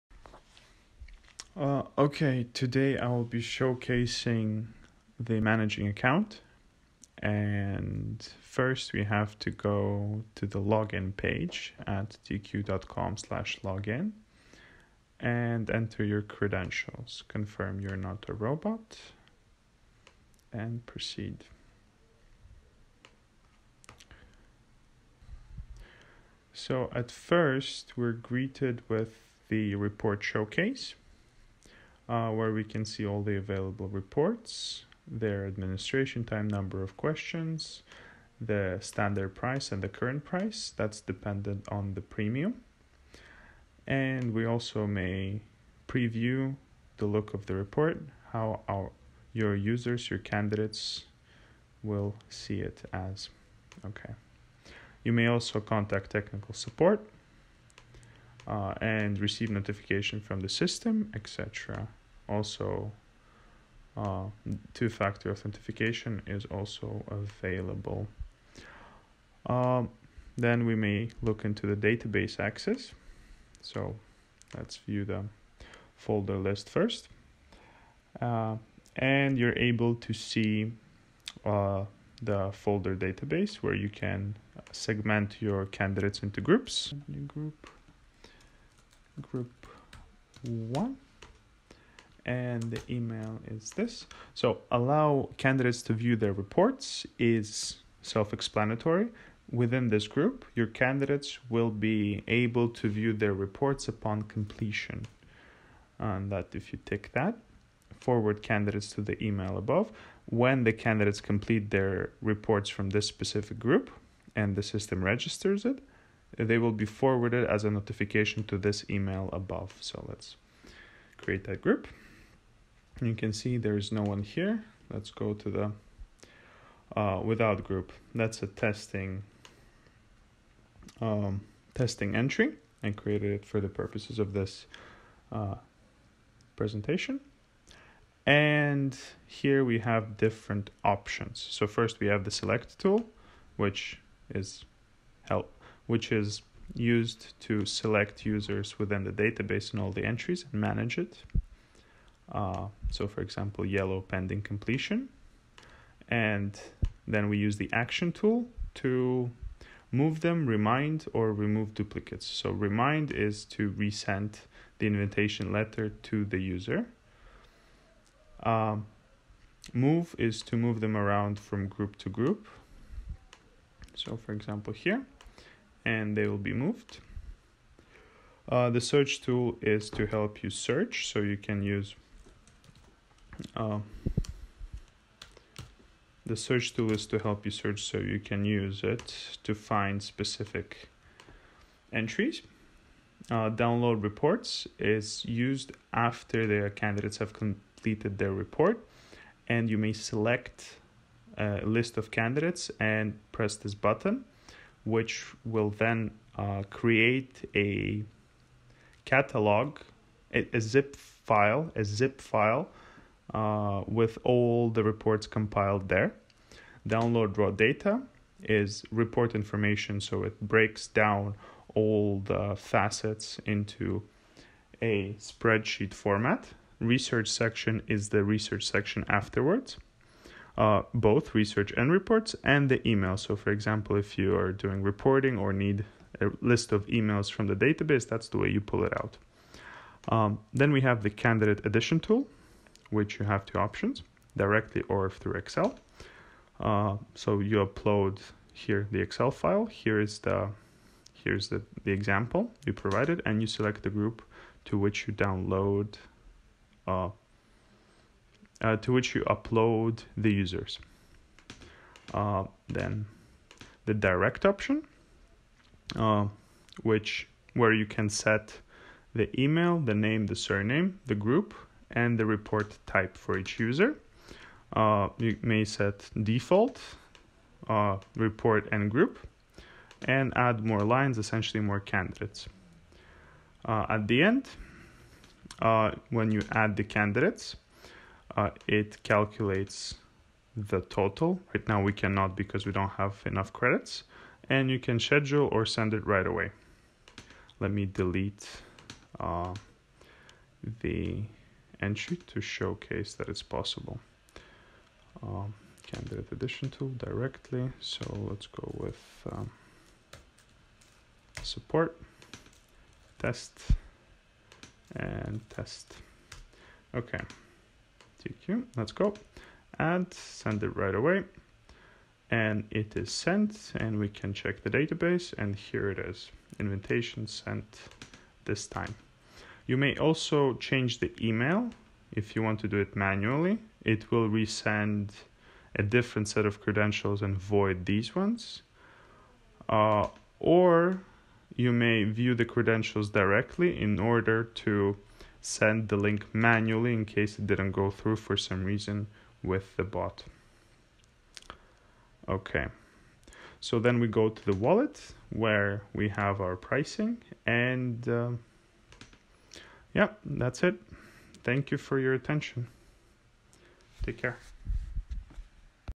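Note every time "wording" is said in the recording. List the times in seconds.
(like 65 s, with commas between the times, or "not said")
not said.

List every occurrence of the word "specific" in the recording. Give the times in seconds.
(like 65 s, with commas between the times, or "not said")
113 s, 190 s.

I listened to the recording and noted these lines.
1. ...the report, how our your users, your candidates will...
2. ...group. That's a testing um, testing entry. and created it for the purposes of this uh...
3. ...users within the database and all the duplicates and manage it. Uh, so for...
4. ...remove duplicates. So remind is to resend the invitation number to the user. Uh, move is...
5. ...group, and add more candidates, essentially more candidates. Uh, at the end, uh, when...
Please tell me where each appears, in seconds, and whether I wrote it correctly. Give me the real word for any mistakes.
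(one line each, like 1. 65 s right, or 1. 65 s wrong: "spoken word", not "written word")
1. 47 s right
2. 127 s right
3. 148 s wrong: "entries", not "duplicates"
4. 161 s wrong: "letter", not "number"
5. 278 s wrong: "lines", not "candidates".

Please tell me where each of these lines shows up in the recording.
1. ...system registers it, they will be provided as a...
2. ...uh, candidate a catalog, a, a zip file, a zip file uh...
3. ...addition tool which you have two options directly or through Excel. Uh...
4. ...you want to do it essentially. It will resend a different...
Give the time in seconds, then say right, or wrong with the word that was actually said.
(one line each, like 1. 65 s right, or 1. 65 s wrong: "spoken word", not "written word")
1. 114 s wrong: "forwarded", not "provided"
2. 206 s wrong: "create", not "candidate"
3. 241 s right
4. 332 s wrong: "manually", not "essentially".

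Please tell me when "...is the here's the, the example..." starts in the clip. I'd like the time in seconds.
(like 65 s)
249 s.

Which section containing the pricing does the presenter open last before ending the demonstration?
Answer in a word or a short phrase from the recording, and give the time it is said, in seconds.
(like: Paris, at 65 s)
The wallet, at 354 s.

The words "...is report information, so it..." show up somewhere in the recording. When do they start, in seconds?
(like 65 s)
218 s.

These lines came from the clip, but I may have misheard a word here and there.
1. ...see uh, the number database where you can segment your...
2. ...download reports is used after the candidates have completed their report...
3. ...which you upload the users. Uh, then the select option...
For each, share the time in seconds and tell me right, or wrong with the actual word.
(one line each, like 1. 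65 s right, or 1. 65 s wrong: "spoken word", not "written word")
1. 80 s wrong: "folder", not "number"
2. 193 s right
3. 258 s wrong: "direct", not "select".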